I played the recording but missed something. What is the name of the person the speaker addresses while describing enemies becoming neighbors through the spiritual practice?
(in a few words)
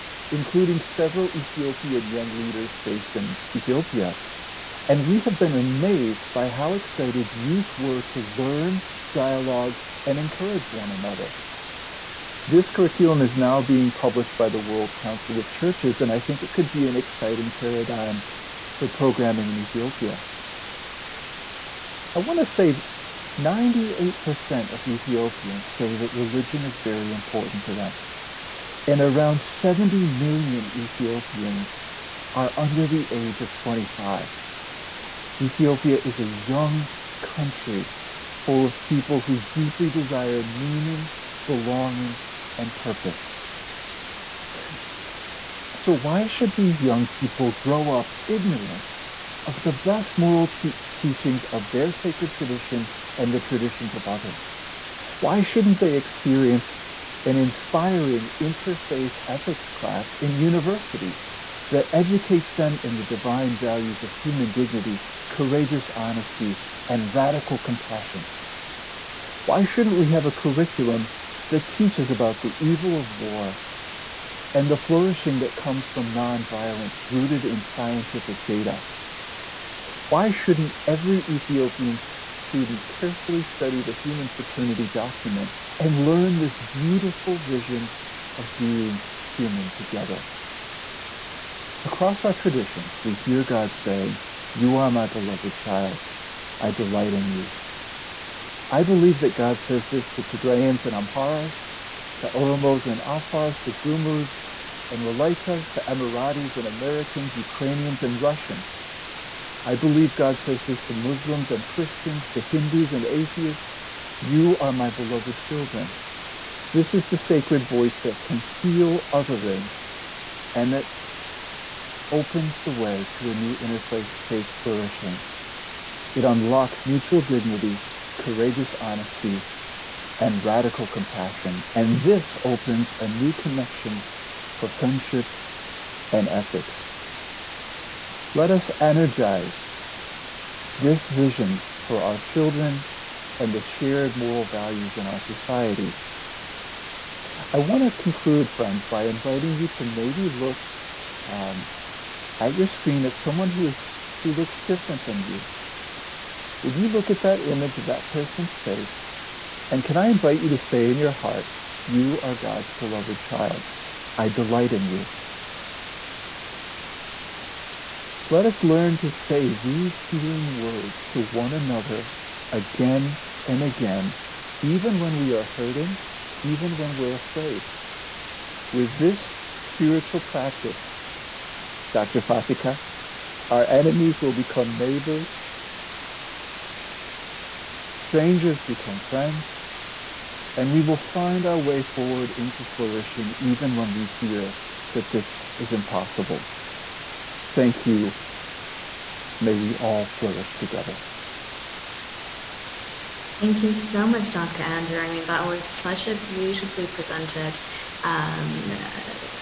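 Dr. Fasika.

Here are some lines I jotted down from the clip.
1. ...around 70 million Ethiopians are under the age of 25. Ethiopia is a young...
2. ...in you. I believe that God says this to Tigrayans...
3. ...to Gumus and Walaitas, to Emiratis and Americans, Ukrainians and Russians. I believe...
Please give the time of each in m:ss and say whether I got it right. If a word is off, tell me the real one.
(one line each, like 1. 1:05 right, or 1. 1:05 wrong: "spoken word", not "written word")
1. 0:29 right
2. 1:37 right
3. 1:43 right.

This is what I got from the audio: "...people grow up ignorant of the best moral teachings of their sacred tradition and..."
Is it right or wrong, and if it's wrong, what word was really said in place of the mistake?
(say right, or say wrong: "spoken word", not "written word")
right.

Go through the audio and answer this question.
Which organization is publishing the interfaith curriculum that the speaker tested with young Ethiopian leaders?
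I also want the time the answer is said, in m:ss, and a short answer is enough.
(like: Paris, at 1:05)
World Council of Churches, at 0:14.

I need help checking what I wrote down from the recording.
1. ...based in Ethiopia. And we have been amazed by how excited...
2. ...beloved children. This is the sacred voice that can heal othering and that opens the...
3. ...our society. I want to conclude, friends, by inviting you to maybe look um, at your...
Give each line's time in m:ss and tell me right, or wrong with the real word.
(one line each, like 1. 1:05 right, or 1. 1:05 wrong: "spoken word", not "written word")
1. 0:02 right
2. 1:54 right
3. 2:25 right.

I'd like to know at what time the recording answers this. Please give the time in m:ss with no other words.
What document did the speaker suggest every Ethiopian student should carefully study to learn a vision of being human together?
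1:23.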